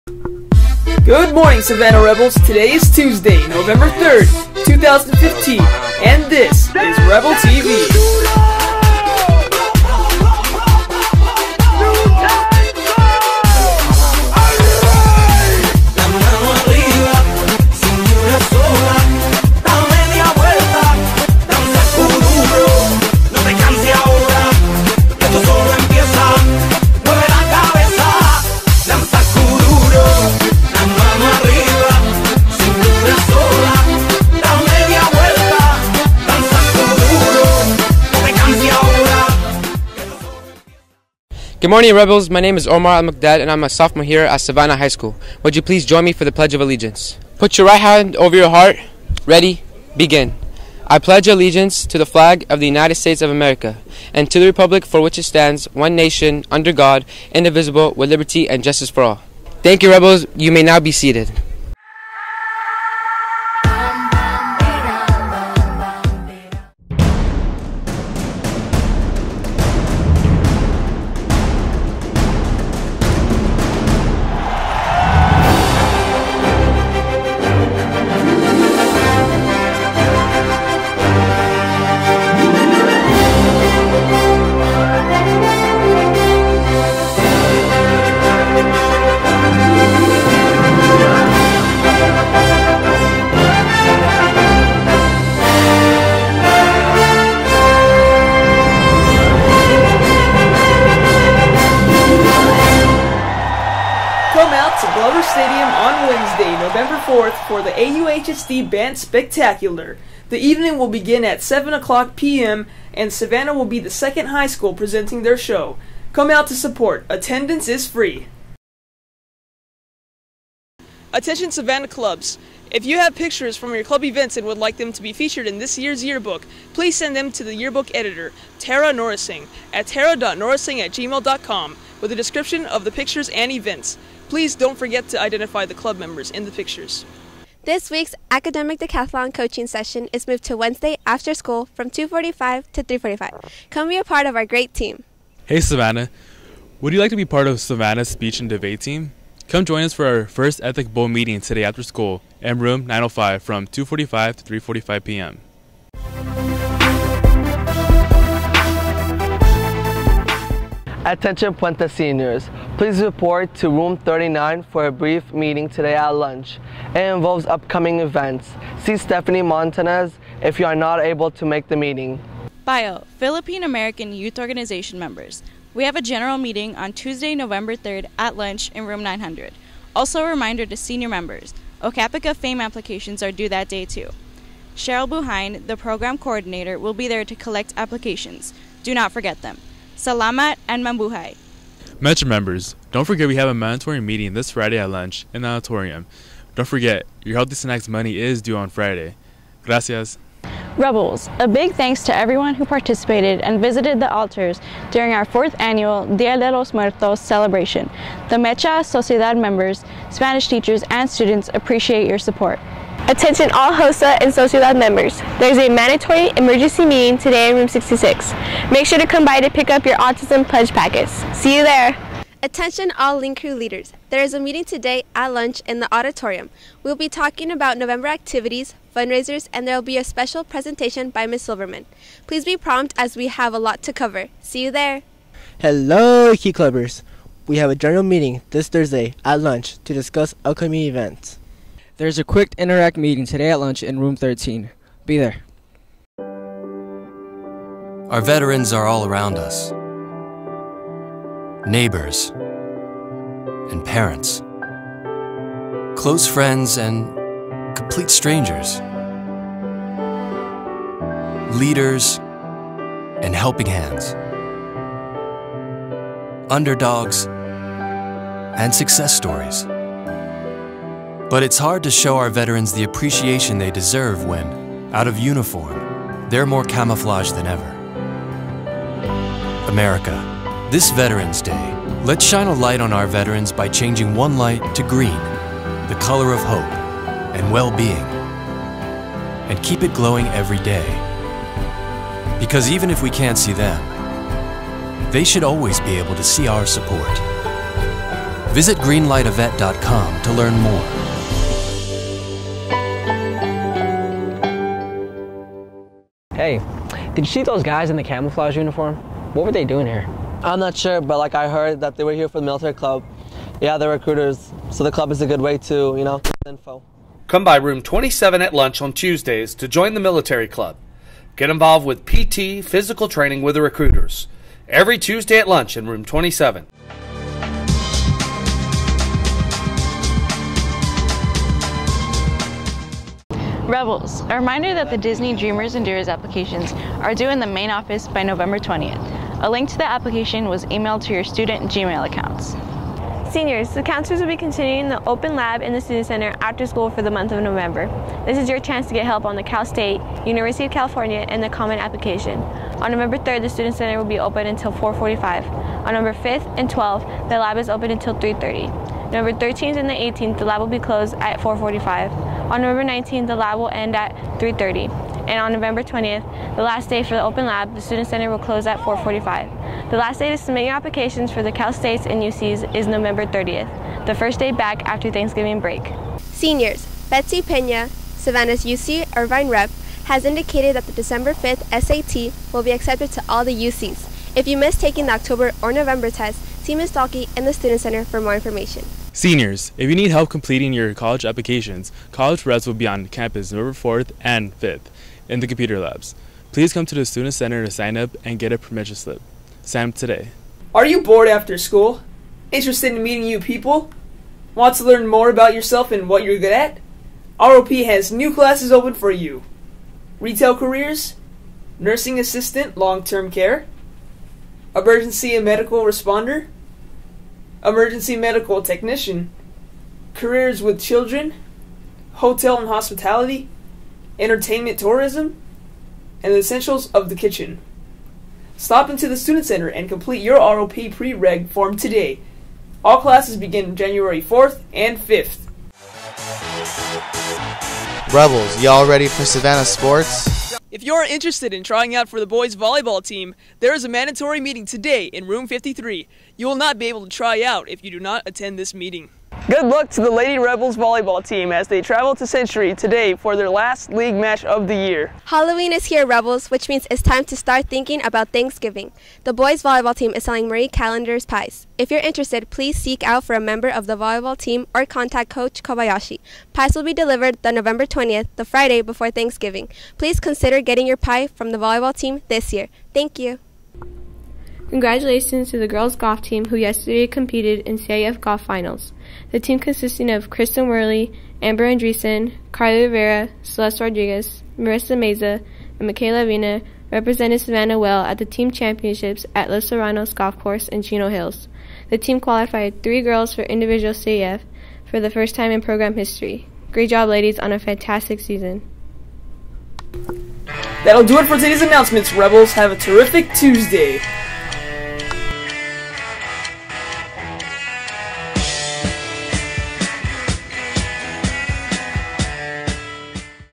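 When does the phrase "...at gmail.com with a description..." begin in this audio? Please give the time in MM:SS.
02:10.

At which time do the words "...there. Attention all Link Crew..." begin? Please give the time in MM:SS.
03:41.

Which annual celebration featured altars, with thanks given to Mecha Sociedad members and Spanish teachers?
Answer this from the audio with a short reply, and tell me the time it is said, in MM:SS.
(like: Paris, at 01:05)
Dia de los Muertos, at 03:26.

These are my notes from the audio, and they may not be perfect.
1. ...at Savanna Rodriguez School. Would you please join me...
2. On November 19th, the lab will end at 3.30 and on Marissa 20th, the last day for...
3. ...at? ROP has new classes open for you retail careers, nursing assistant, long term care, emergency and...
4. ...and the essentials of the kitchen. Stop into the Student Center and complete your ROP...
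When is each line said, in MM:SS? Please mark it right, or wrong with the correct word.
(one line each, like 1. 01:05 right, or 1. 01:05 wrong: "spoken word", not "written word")
1. 00:44 wrong: "High", not "Rodriguez"
2. 06:02 wrong: "November", not "Marissa"
3. 06:46 right
4. 07:06 right.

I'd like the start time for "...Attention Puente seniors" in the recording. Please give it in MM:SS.
02:41.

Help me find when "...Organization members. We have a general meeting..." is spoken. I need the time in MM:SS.
02:54.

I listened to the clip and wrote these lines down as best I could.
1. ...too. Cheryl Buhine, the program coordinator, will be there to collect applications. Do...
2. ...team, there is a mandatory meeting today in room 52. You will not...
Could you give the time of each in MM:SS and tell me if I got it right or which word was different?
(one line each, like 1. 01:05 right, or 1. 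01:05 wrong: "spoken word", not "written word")
1. 03:03 right
2. 07:23 wrong: "53", not "52".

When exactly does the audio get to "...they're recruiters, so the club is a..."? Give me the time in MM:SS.
05:13.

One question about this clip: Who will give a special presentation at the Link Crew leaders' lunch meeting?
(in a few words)
Ms. Silverman.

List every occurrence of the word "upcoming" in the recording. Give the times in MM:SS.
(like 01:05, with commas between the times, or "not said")
02:47, 04:00.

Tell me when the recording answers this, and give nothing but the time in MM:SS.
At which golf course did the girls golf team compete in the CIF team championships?
08:09.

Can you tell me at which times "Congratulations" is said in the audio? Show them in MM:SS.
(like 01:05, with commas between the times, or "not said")
07:54.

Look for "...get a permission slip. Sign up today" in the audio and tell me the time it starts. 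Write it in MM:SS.
06:38.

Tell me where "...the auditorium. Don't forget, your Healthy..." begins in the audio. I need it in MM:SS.
03:15.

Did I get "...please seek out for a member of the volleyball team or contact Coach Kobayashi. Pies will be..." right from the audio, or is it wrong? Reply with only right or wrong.
right.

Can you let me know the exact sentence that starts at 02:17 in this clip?
This week's academic decathlon coaching session is moved to Wednesday after school from 2:45 to 3:45.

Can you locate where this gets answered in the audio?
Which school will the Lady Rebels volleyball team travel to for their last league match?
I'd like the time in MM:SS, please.
07:32.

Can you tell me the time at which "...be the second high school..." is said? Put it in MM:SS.
01:53.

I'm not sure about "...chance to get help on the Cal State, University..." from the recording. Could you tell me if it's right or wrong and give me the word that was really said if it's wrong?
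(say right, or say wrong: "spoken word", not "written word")
right.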